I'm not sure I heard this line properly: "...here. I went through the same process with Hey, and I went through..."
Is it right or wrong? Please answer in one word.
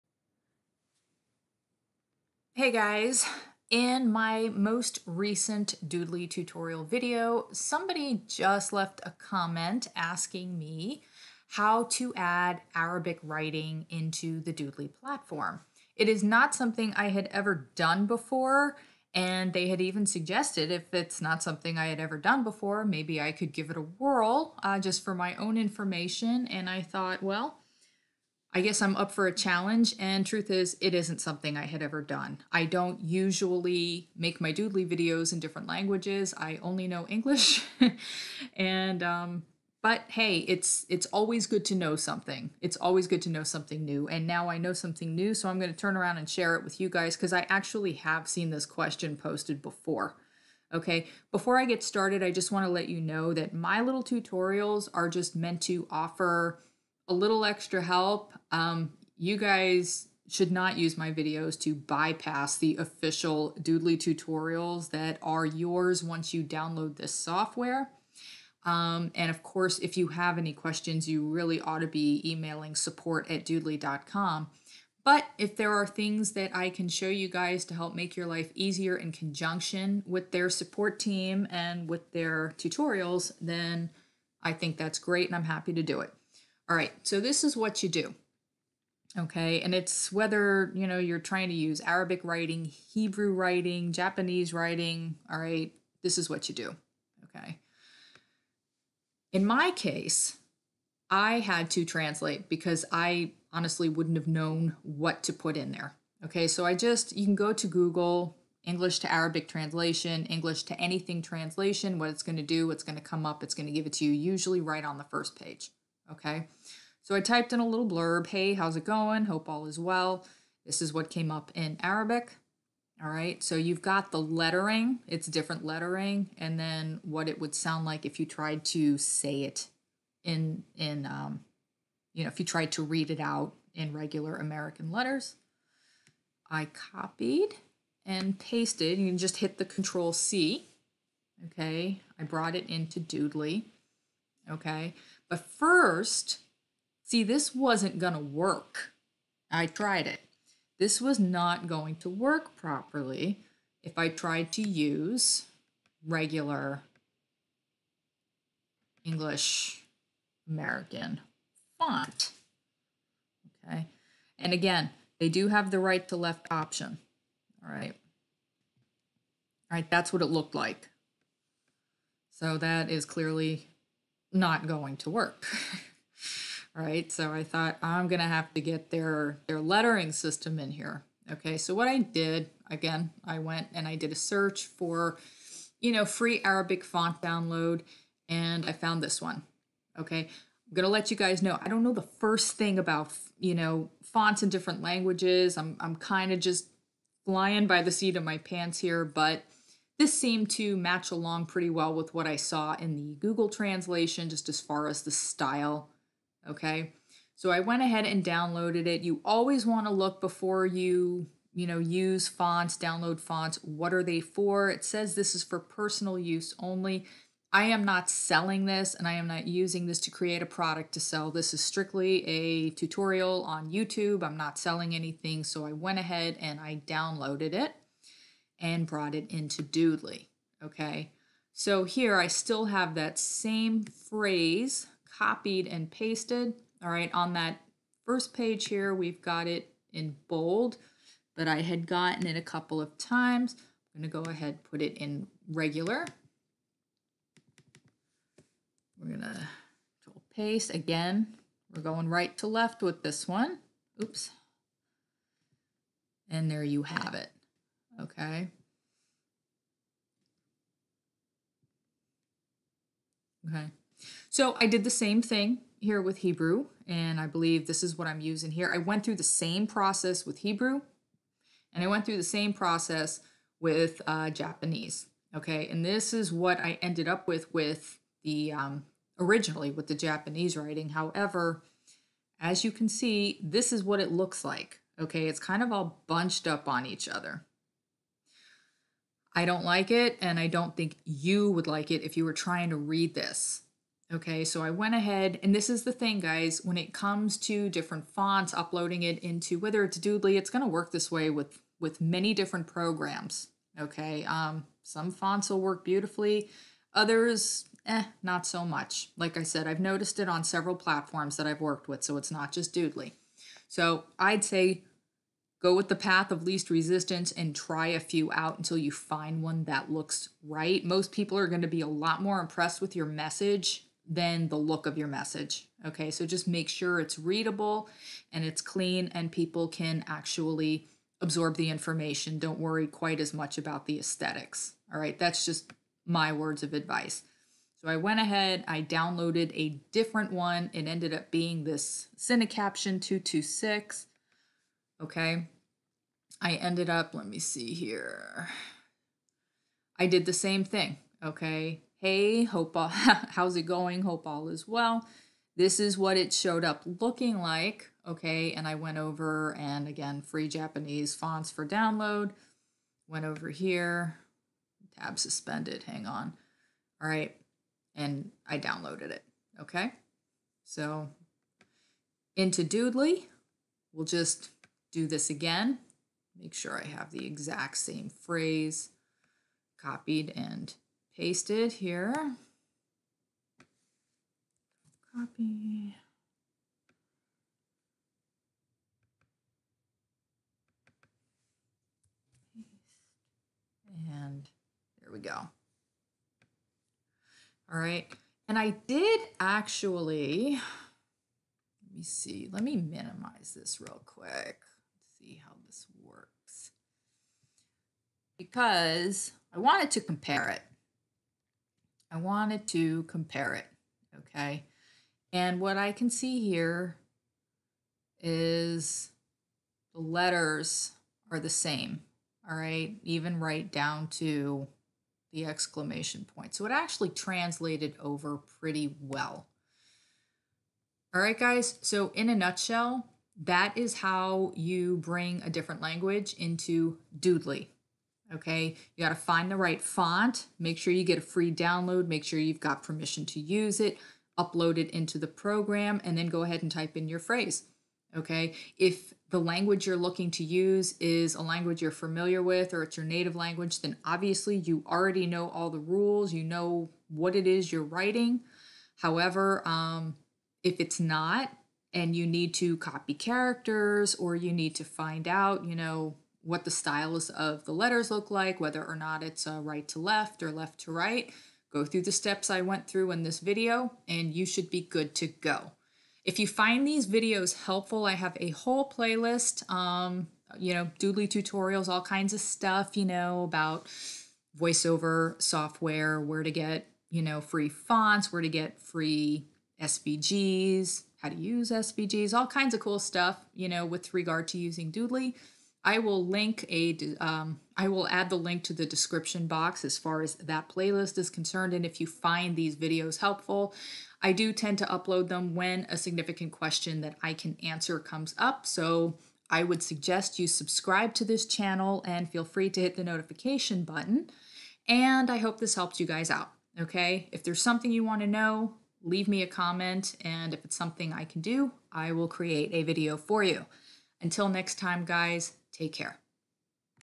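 wrong.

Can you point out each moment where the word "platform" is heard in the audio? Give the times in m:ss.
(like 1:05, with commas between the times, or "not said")
0:14, 5:10.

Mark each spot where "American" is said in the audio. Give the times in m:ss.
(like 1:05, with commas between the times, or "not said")
2:14, 2:40.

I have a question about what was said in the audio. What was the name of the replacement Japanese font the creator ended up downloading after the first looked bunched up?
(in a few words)
Cinecaption 226.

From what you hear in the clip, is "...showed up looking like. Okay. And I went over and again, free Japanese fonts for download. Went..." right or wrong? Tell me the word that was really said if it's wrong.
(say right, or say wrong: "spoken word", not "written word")
right.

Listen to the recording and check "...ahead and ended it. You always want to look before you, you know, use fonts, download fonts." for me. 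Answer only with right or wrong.
wrong.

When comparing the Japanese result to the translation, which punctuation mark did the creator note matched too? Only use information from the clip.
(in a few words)
Exclamation point.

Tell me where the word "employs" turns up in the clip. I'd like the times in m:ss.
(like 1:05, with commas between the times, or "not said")
not said.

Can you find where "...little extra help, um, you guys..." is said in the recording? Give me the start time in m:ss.
0:57.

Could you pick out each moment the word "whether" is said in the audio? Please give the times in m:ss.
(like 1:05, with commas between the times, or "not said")
1:30, 4:59, 7:48.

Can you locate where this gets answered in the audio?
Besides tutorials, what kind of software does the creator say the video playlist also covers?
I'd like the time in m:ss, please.
8:04.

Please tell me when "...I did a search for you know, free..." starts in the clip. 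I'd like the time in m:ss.
3:03.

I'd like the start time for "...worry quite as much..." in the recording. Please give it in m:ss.
5:32.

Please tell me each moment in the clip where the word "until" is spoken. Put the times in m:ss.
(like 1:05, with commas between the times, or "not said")
5:18, 8:44.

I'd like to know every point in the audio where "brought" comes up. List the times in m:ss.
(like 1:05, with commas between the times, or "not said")
2:22, 3:48.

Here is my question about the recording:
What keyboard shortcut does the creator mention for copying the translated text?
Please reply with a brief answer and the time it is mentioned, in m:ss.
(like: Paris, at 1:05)
Control C, at 2:19.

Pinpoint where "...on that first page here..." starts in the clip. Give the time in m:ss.
3:57.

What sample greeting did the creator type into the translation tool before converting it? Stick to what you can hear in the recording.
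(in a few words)
Hey, how's it going? Hope all is well.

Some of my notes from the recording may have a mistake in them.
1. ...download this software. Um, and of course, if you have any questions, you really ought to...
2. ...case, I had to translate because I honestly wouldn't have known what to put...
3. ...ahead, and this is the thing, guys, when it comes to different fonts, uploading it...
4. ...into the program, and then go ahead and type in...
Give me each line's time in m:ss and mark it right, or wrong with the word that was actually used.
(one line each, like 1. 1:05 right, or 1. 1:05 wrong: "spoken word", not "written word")
1. 1:06 right
2. 1:39 right
3. 4:54 right
4. 7:24 right.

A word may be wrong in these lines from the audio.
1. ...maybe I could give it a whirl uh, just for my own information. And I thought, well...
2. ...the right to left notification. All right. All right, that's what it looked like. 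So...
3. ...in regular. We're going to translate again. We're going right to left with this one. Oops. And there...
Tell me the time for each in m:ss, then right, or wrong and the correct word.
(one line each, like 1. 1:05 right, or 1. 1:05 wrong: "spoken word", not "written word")
1. 0:22 right
2. 2:45 wrong: "option", not "notification"
3. 4:04 wrong: "paste", not "translate".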